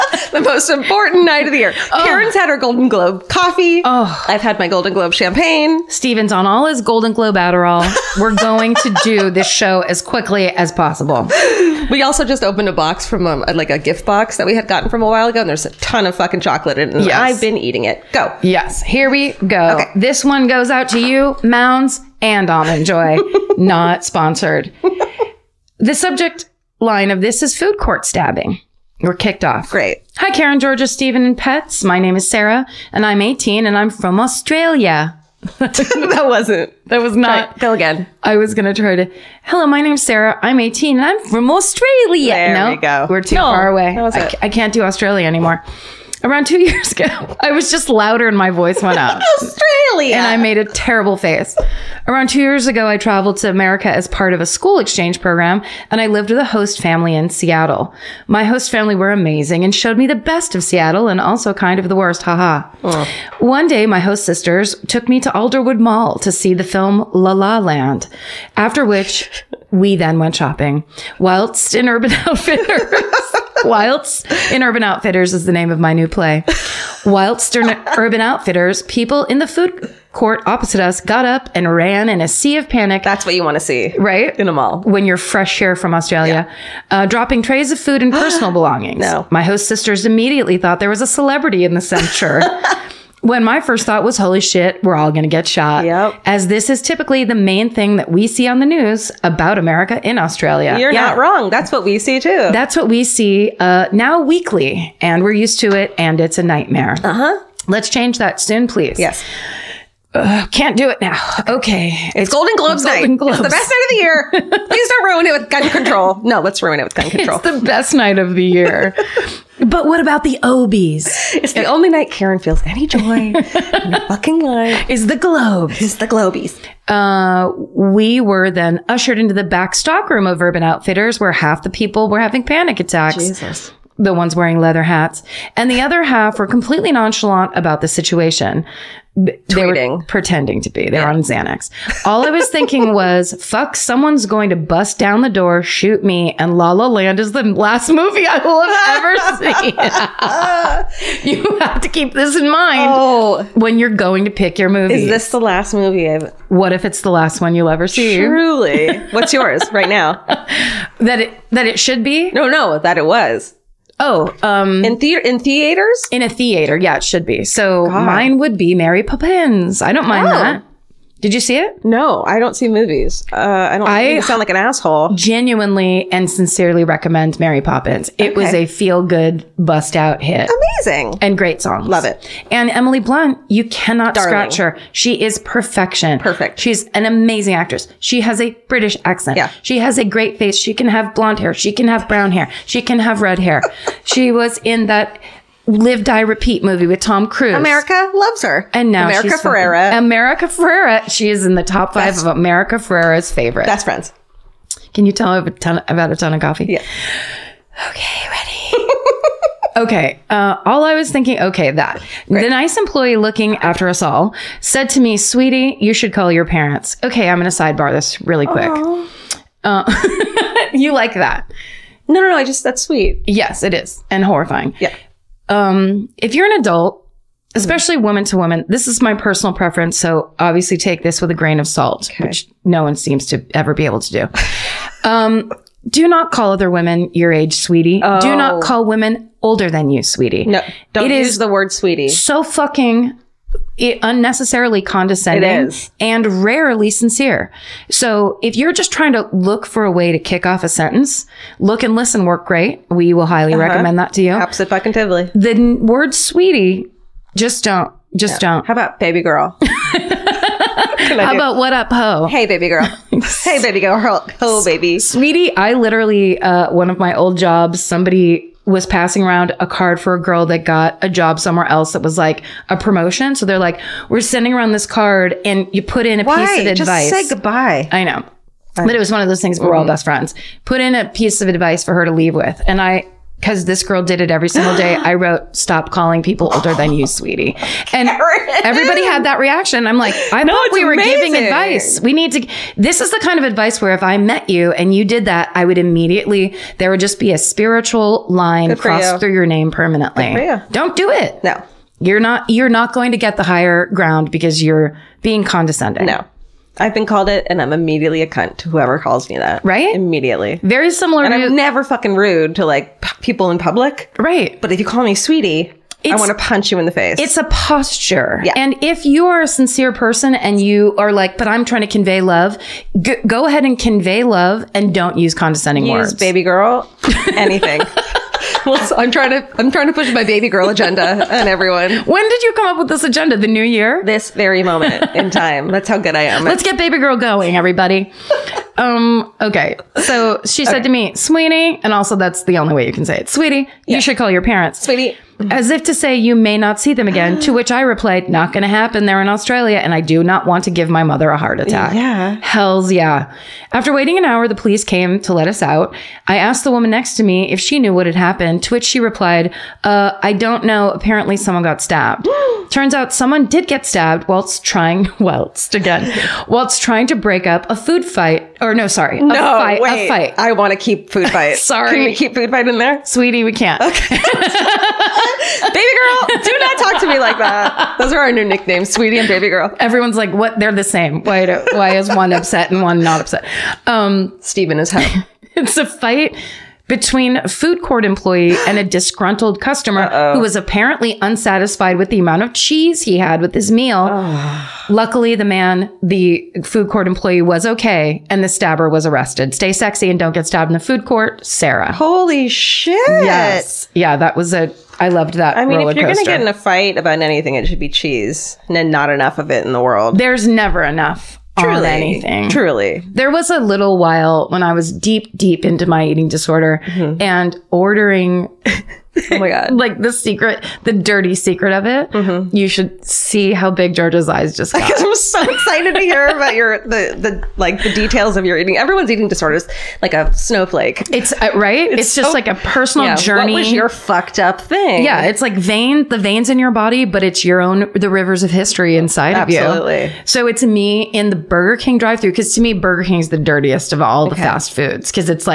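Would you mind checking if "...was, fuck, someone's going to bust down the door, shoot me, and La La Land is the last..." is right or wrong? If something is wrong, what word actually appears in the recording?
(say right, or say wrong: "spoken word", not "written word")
right.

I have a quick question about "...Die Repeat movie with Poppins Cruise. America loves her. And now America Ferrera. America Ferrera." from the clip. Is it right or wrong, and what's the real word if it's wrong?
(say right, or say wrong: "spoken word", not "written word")
wrong: "Tom", not "Poppins".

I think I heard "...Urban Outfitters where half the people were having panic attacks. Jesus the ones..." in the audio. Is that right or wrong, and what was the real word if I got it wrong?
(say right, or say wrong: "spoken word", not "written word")
right.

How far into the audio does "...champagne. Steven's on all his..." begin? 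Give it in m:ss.
0:05.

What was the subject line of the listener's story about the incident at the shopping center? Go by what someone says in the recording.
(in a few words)
Food court stabbing.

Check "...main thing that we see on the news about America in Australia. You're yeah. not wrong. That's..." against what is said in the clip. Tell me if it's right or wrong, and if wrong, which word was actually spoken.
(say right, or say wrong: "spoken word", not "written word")
right.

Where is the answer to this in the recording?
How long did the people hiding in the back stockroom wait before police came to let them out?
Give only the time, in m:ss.
5:54.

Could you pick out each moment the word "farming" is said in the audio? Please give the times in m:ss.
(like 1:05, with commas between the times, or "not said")
not said.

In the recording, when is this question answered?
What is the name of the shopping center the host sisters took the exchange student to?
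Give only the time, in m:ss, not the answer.
1:05.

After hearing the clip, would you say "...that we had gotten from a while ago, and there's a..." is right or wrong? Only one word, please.
right.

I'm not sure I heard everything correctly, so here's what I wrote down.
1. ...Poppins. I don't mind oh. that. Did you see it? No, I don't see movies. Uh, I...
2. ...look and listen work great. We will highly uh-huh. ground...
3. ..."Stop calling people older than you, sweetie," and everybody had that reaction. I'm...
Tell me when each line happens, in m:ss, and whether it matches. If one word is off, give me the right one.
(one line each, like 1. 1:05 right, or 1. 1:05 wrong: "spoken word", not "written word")
1. 2:49 right
2. 4:11 wrong: "recommend", not "ground"
3. 4:45 right.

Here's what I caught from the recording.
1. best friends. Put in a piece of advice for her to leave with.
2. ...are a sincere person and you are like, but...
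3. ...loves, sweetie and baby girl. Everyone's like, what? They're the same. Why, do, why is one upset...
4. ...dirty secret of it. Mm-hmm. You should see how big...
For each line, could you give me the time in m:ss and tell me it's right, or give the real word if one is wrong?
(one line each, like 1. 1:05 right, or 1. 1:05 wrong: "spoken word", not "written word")
1. 4:39 right
2. 5:19 right
3. 6:18 wrong: "nicknames", not "loves"
4. 7:00 right.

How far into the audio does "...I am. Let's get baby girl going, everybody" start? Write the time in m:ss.
5:36.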